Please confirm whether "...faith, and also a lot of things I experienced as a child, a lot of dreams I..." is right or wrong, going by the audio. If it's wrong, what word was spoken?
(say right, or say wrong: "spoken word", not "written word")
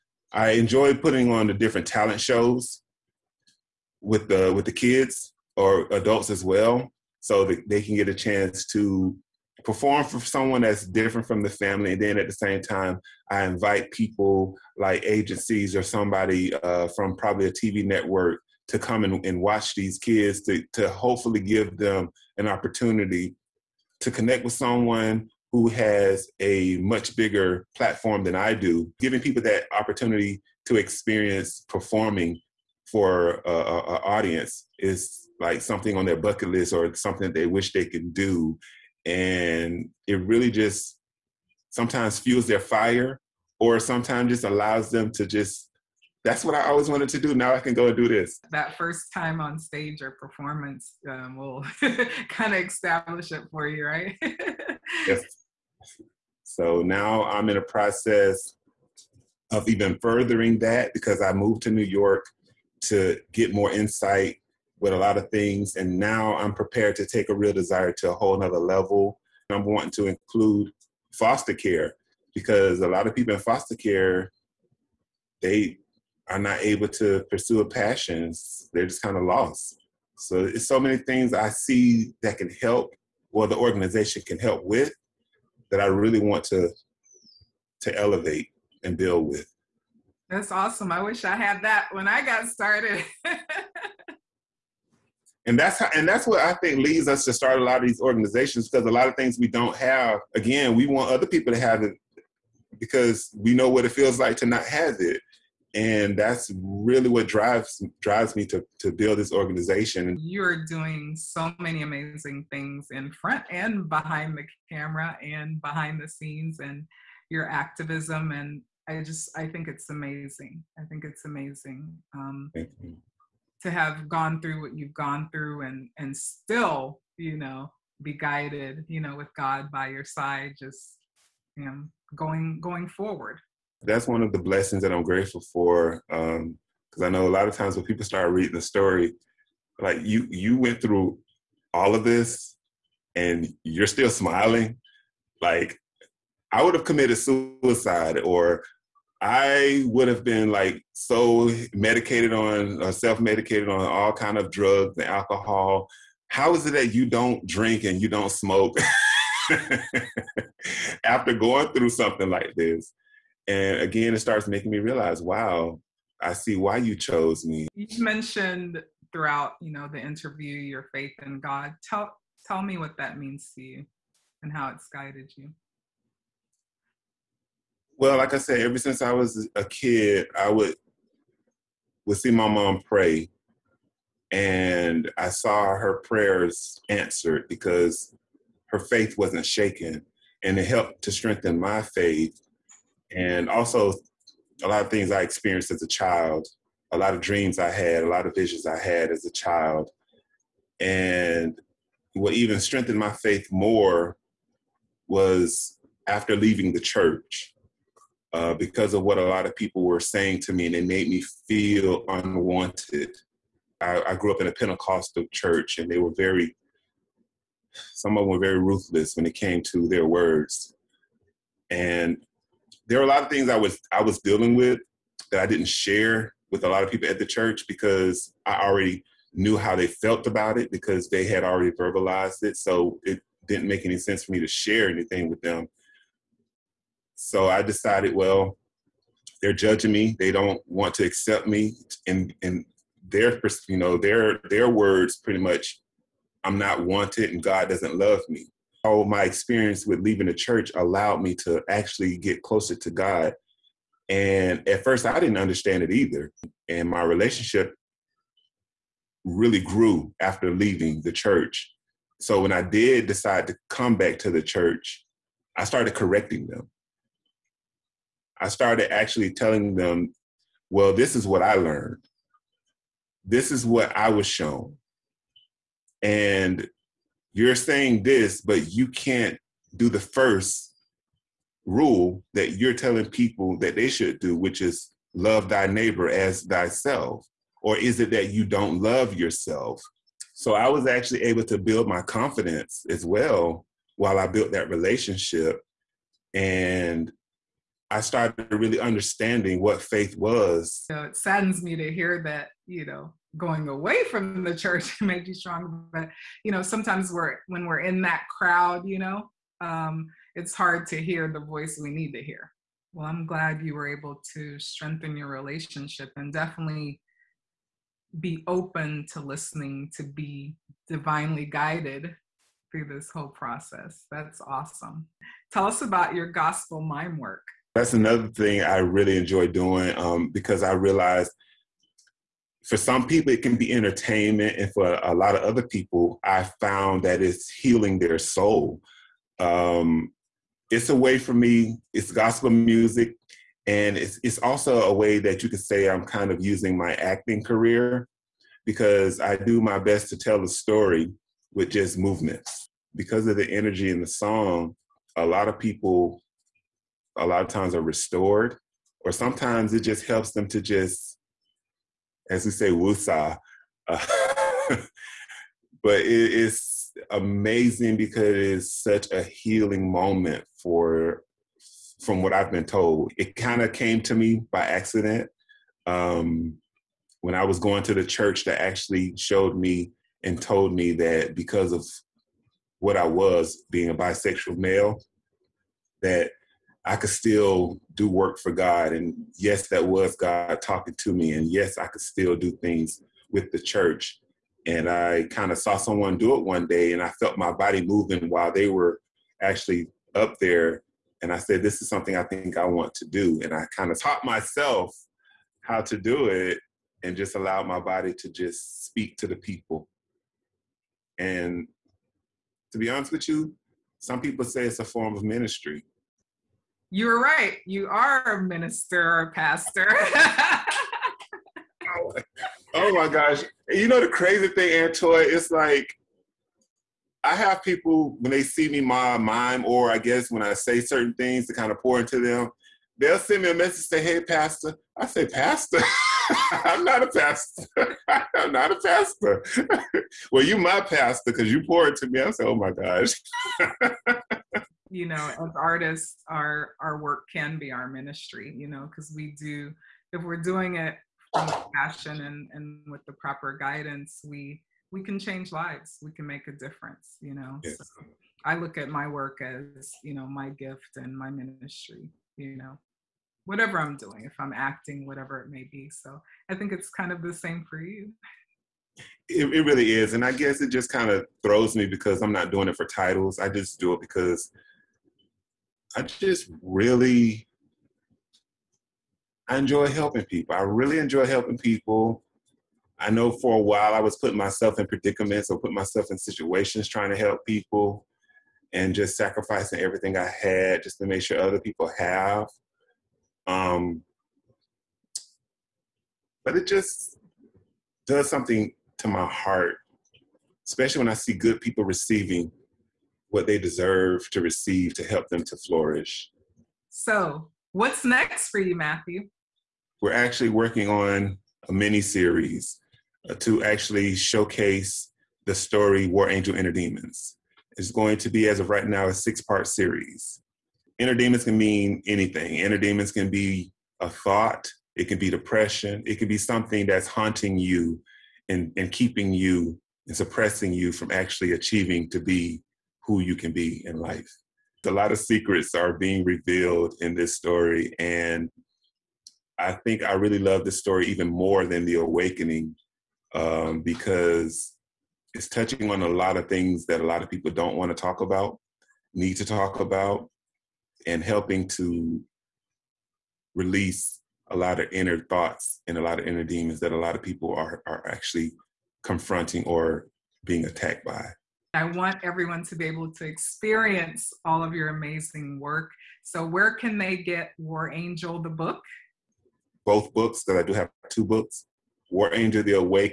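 right.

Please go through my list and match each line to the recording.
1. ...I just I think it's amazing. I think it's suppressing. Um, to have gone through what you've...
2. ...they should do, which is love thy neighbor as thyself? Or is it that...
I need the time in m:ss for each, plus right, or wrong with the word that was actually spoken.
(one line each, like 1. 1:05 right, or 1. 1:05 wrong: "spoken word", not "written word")
1. 1:58 wrong: "amazing", not "suppressing"
2. 4:43 right.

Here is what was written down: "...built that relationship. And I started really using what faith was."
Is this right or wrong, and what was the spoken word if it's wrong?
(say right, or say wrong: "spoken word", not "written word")
wrong: "understanding", not "using".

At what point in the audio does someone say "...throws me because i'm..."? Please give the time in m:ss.
7:51.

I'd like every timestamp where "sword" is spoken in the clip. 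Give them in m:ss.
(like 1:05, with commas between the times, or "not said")
not said.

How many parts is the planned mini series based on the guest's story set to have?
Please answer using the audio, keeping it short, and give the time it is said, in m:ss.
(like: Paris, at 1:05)
6, at 8:39.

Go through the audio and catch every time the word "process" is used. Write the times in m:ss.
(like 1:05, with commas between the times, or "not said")
0:57, 5:23.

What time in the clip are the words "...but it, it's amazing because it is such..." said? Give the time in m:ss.
6:05.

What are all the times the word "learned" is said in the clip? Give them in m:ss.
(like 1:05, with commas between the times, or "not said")
4:31.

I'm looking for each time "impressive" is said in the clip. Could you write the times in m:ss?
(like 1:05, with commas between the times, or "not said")
not said.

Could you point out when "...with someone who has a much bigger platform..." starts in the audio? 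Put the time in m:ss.
0:24.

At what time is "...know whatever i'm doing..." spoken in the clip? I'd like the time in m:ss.
7:42.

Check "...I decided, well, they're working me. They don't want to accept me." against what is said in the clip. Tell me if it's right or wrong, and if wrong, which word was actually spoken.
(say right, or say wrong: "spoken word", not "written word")
wrong: "judging", not "working".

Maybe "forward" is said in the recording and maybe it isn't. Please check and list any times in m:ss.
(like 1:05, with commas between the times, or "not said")
2:12.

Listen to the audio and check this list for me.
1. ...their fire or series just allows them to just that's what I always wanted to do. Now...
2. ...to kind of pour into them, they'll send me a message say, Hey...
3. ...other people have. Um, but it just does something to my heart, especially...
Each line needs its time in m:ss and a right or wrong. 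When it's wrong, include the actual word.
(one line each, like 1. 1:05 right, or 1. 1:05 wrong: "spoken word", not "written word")
1. 0:42 wrong: "sometimes", not "series"
2. 7:11 right
3. 8:11 right.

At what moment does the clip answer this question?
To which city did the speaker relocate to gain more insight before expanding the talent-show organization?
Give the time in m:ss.
1:01.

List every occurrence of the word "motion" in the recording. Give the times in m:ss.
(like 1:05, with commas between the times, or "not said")
not said.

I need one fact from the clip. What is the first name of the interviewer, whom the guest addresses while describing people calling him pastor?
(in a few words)
Antoy.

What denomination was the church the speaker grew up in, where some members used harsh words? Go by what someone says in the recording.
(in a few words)
Pentecostal.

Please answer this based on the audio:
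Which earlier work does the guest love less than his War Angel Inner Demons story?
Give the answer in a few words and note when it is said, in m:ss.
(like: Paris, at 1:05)
The Awakening, at 9:01.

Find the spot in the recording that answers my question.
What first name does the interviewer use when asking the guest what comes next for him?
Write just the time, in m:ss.
8:28.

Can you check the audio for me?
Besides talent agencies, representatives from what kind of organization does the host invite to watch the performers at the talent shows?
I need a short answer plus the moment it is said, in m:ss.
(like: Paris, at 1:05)
TV network, at 0:17.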